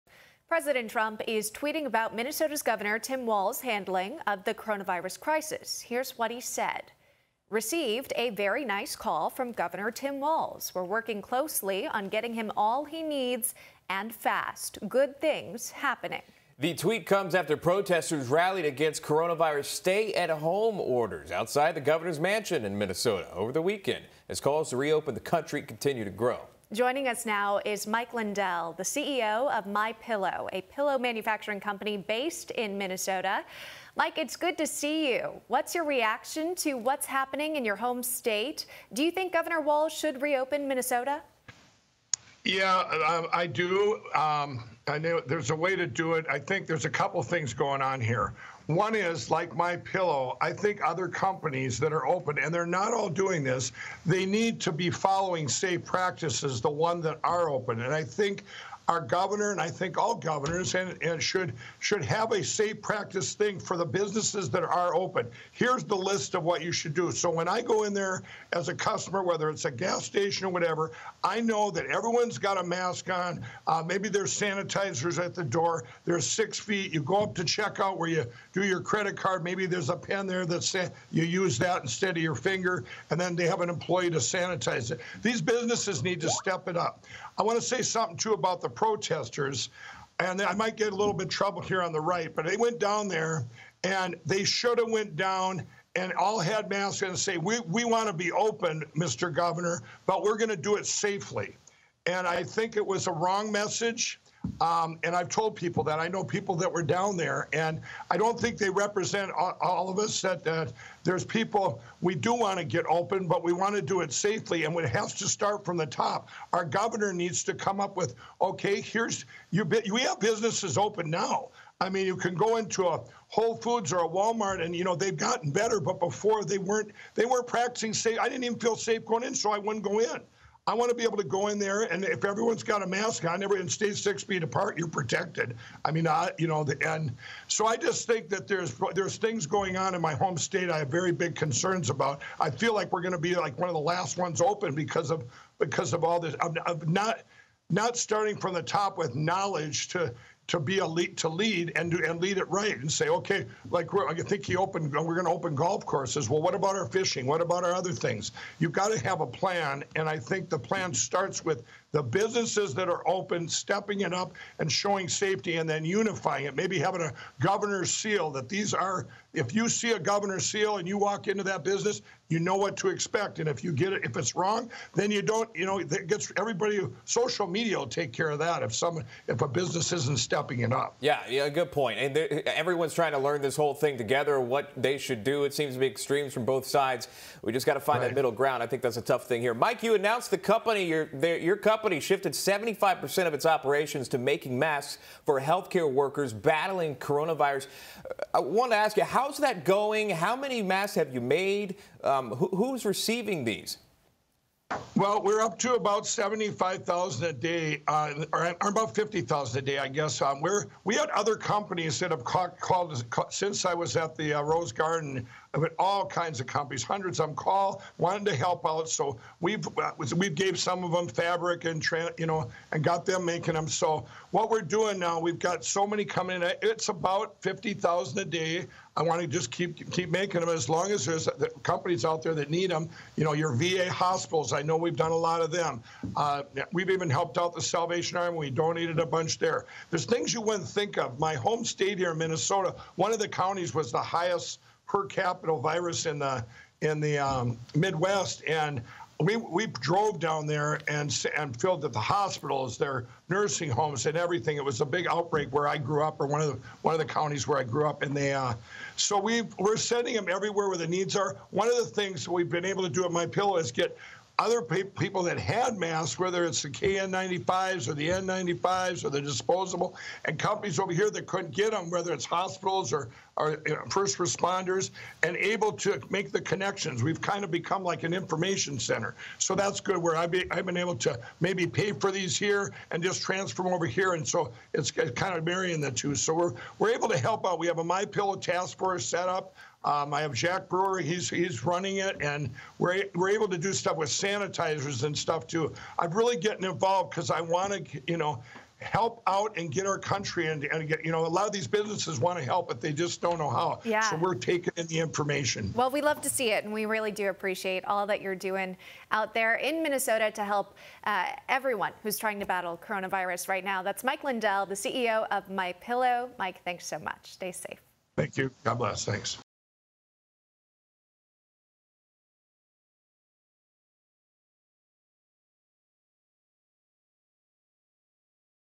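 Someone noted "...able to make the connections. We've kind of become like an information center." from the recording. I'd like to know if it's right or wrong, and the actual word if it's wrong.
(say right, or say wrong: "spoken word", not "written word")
right.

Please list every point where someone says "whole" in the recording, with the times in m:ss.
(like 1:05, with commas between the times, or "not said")
2:03, 3:03.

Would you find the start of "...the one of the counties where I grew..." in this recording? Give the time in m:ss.
4:16.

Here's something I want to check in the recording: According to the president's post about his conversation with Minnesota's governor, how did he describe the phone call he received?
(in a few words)
very nice call.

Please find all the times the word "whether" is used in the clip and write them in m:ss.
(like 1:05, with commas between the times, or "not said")
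1:09, 4:26, 4:31.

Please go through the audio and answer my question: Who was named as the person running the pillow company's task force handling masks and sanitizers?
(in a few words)
Jack Brewer.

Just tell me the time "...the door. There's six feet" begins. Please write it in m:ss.
1:15.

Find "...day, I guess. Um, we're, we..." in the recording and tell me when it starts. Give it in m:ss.
3:29.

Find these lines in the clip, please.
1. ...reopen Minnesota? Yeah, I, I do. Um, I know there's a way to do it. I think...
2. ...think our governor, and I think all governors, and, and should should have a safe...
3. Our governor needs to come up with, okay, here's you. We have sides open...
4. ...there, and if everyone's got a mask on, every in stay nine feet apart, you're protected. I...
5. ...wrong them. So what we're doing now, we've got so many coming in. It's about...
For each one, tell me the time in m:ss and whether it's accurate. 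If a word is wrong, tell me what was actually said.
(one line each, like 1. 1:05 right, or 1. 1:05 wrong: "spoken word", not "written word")
1. 0:40 right
2. 0:58 right
3. 1:56 wrong: "businesses", not "sides"
4. 2:11 wrong: "six", not "nine"
5. 3:43 wrong: "making", not "wrong".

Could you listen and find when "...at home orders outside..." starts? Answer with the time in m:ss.
0:20.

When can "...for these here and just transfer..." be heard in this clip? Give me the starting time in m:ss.
4:41.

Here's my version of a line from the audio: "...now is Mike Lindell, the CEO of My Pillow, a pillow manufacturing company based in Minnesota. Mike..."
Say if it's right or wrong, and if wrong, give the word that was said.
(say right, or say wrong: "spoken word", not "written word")
right.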